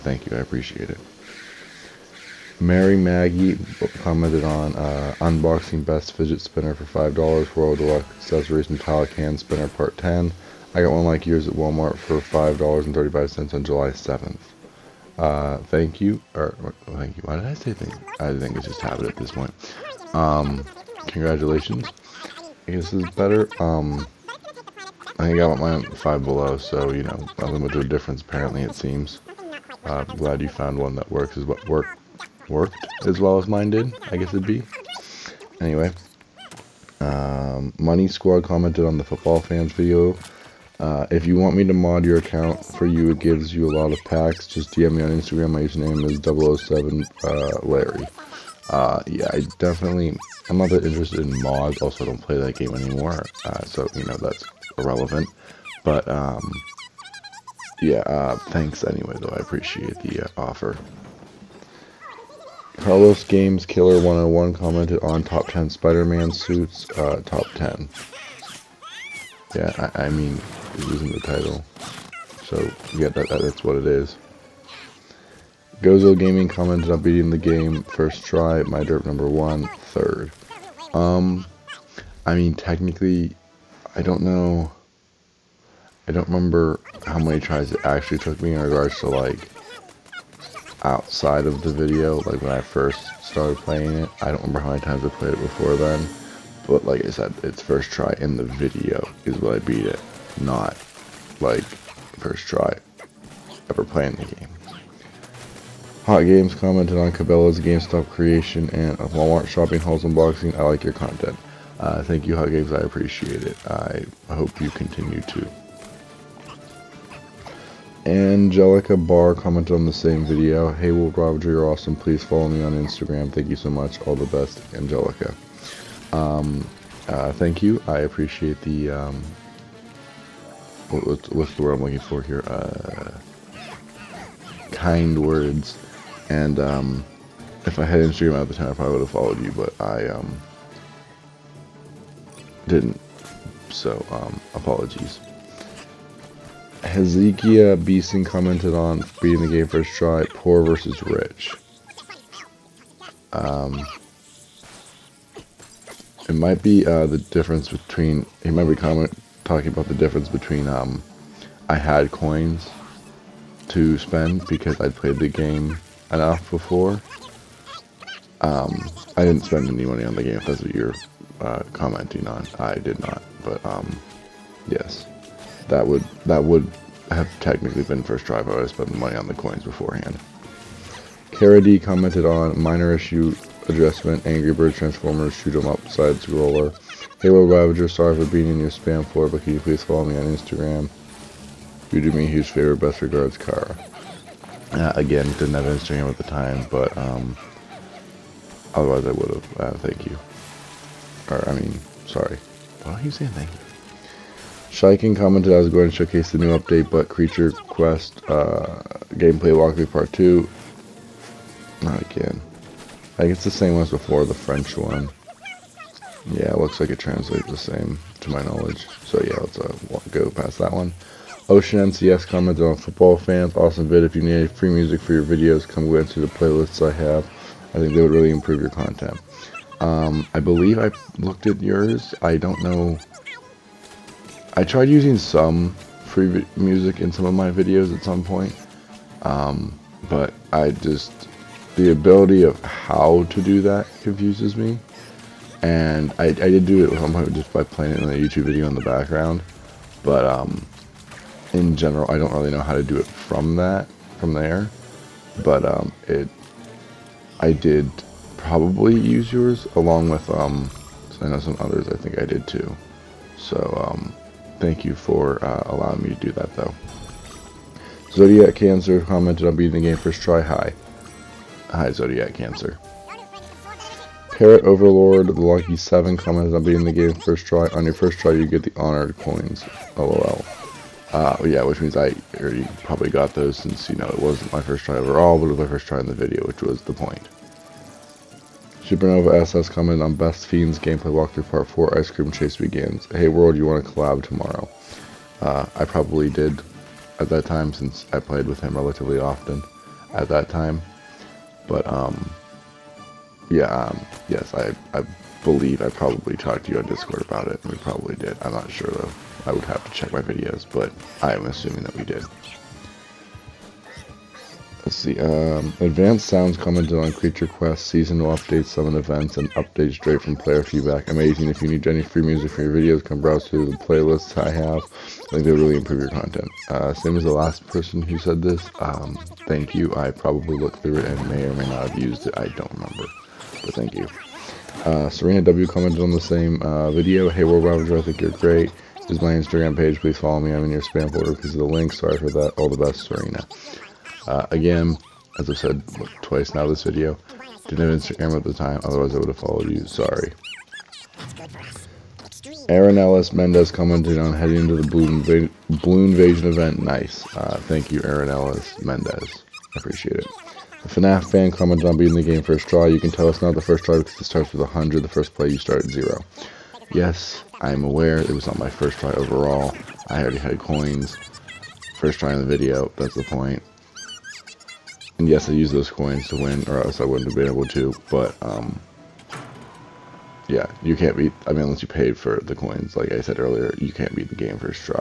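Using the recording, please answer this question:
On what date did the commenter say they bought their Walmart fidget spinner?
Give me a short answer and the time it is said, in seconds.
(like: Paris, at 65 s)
July 7, at 13 s.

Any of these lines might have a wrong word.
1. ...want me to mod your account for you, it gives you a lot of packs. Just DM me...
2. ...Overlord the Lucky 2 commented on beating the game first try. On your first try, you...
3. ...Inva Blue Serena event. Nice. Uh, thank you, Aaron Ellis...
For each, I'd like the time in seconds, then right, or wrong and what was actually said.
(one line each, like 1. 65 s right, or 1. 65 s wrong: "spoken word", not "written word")
1. 41 s right
2. 274 s wrong: "7", not "2"
3. 355 s wrong: "Invasion", not "Serena".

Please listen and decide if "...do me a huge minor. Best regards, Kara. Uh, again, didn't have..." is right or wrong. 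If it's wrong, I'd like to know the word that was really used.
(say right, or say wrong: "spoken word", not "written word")
wrong: "favor", not "minor".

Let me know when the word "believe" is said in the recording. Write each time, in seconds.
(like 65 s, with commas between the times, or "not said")
230 s, 305 s.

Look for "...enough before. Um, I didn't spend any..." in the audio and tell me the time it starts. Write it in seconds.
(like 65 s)
166 s.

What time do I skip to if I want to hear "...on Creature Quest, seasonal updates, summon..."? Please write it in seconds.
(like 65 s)
316 s.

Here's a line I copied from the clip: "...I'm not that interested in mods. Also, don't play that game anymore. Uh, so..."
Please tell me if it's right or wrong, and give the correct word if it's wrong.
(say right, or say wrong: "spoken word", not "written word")
right.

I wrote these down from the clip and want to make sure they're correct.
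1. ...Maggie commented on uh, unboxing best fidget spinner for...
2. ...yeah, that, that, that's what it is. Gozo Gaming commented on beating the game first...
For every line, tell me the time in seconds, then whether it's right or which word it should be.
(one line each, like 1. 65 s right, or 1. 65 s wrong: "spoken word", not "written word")
1. 2 s right
2. 72 s right.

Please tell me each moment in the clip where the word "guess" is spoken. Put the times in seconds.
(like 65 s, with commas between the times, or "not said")
22 s, 34 s.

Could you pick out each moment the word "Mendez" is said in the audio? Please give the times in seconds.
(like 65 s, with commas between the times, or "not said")
353 s, 358 s.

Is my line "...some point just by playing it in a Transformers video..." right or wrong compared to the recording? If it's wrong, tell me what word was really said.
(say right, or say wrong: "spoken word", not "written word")
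wrong: "YouTube", not "Transformers".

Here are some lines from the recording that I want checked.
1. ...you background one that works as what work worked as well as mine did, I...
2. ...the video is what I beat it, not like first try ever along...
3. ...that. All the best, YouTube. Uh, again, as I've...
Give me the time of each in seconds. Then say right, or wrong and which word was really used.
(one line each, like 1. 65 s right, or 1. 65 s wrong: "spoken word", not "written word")
1. 30 s wrong: "found", not "background"
2. 98 s wrong: "playing", not "along"
3. 342 s wrong: "Serena", not "YouTube".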